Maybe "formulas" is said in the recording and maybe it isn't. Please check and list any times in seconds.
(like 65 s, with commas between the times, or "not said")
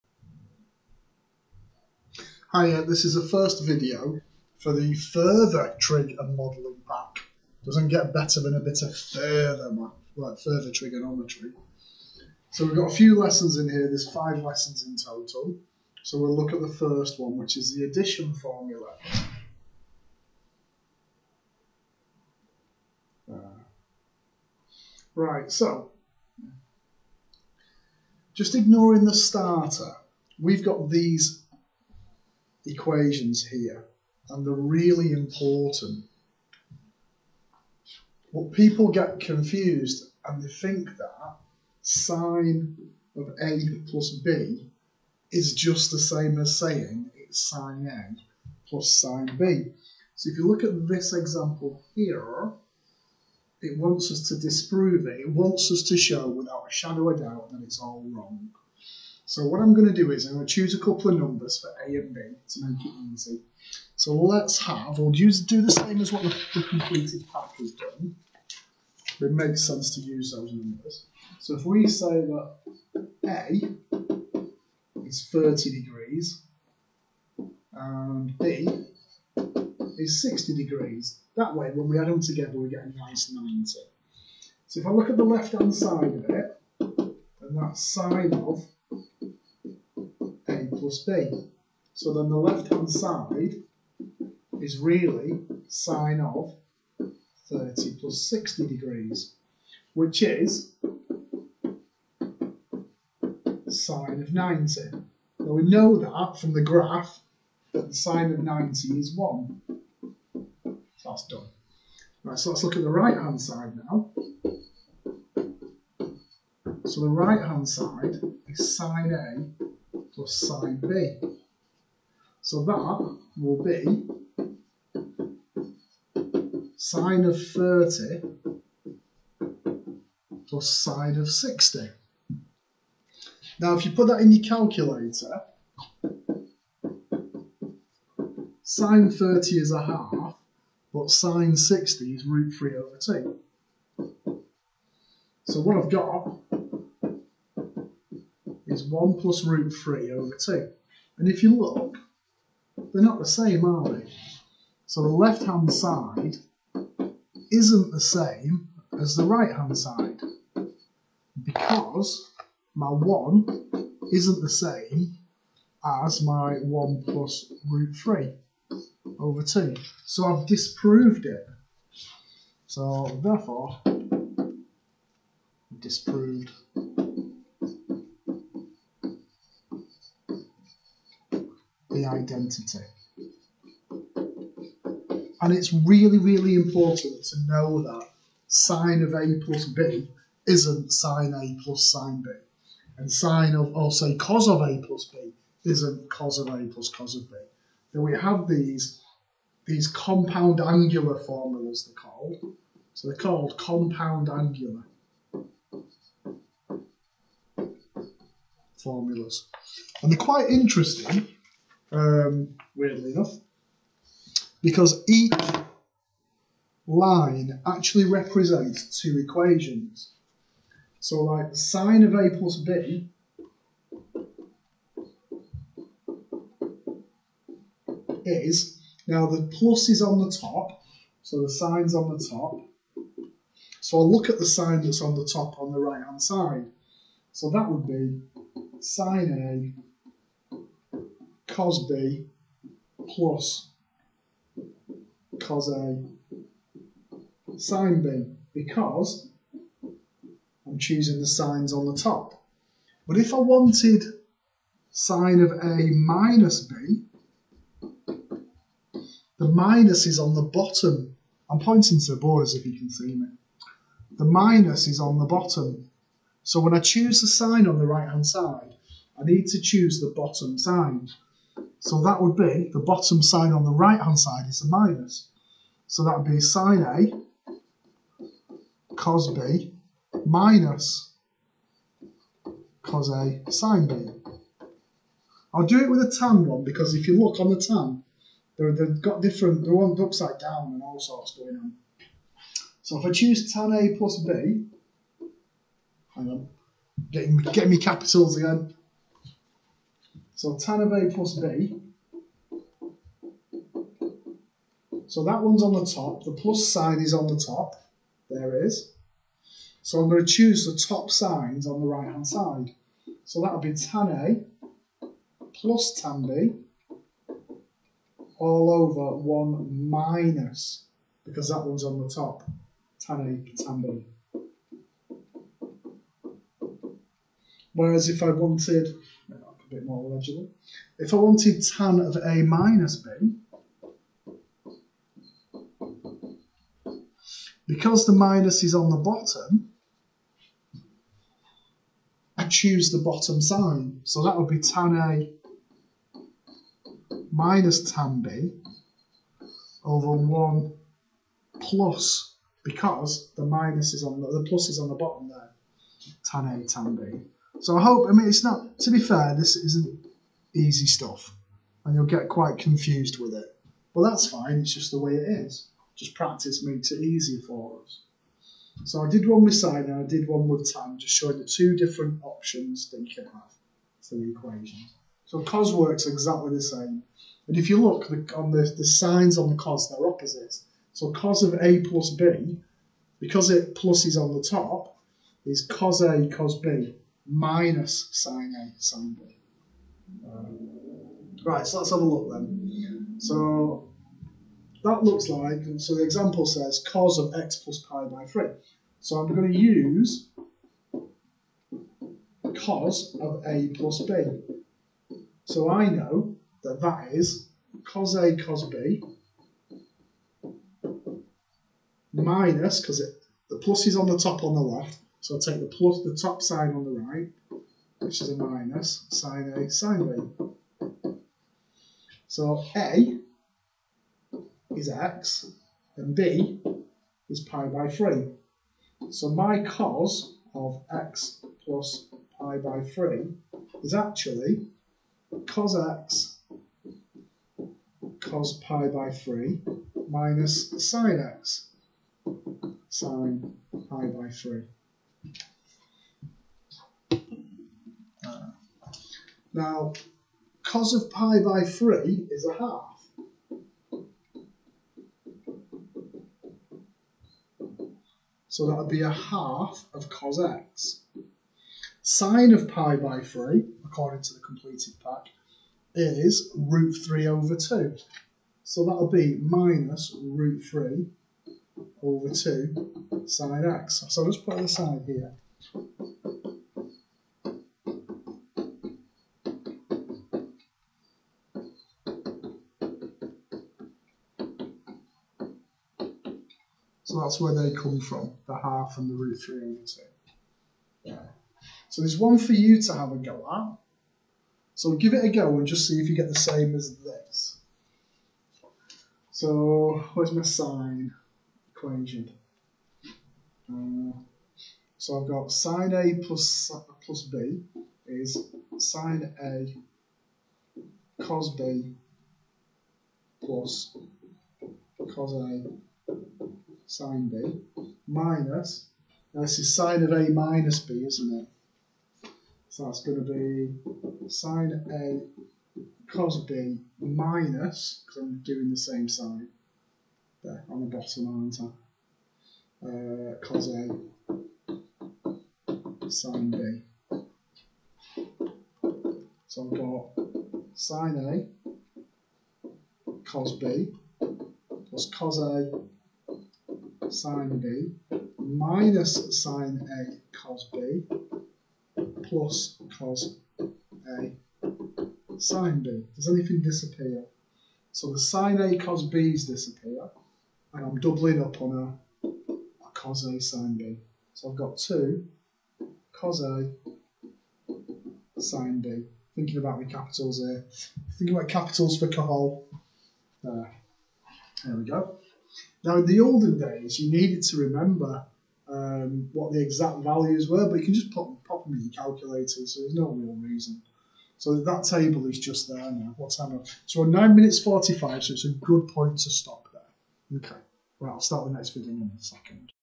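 18 s, 201 s, 208 s.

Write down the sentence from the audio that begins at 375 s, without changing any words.
So cos works exactly the same.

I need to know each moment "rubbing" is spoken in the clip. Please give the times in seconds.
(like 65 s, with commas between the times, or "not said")
not said.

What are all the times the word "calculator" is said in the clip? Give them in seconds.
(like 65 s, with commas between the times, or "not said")
134 s, 581 s.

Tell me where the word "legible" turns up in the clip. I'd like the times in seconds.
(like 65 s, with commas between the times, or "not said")
330 s.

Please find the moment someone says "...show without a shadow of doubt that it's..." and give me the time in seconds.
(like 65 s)
55 s.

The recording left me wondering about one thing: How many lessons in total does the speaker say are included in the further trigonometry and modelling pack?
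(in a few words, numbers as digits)
5.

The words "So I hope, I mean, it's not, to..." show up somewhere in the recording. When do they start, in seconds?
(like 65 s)
357 s.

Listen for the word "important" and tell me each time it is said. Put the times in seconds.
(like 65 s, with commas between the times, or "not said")
35 s, 186 s.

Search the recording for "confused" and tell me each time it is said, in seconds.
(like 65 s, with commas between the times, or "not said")
39 s, 362 s.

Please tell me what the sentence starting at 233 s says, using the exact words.
So I'll look at the sine that's on the top on the right hand side.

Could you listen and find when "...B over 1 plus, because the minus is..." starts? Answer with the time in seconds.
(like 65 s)
348 s.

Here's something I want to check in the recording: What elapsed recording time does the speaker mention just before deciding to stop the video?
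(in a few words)
9 minutes 45.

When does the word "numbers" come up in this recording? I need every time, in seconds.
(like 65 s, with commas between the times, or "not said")
61 s, 70 s.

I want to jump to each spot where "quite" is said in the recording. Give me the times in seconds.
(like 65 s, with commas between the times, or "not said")
210 s, 362 s.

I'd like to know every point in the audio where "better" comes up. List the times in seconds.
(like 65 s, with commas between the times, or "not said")
8 s.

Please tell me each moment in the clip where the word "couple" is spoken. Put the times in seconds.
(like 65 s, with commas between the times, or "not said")
60 s.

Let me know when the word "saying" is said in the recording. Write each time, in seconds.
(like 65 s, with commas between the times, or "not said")
46 s.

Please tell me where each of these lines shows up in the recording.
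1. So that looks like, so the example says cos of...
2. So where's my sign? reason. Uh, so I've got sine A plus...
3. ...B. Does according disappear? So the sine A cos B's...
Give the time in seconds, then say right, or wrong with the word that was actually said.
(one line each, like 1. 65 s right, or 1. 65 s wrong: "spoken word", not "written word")
1. 393 s right
2. 499 s wrong: "equation", not "reason"
3. 555 s wrong: "anything", not "according".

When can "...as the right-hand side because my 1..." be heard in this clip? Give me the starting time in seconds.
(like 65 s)
158 s.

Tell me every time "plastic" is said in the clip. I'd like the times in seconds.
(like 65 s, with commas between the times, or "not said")
not said.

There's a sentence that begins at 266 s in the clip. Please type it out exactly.
So when I choose the sign on the right hand side, I need to choose the bottom sign.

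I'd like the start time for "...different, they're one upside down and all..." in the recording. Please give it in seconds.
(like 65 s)
289 s.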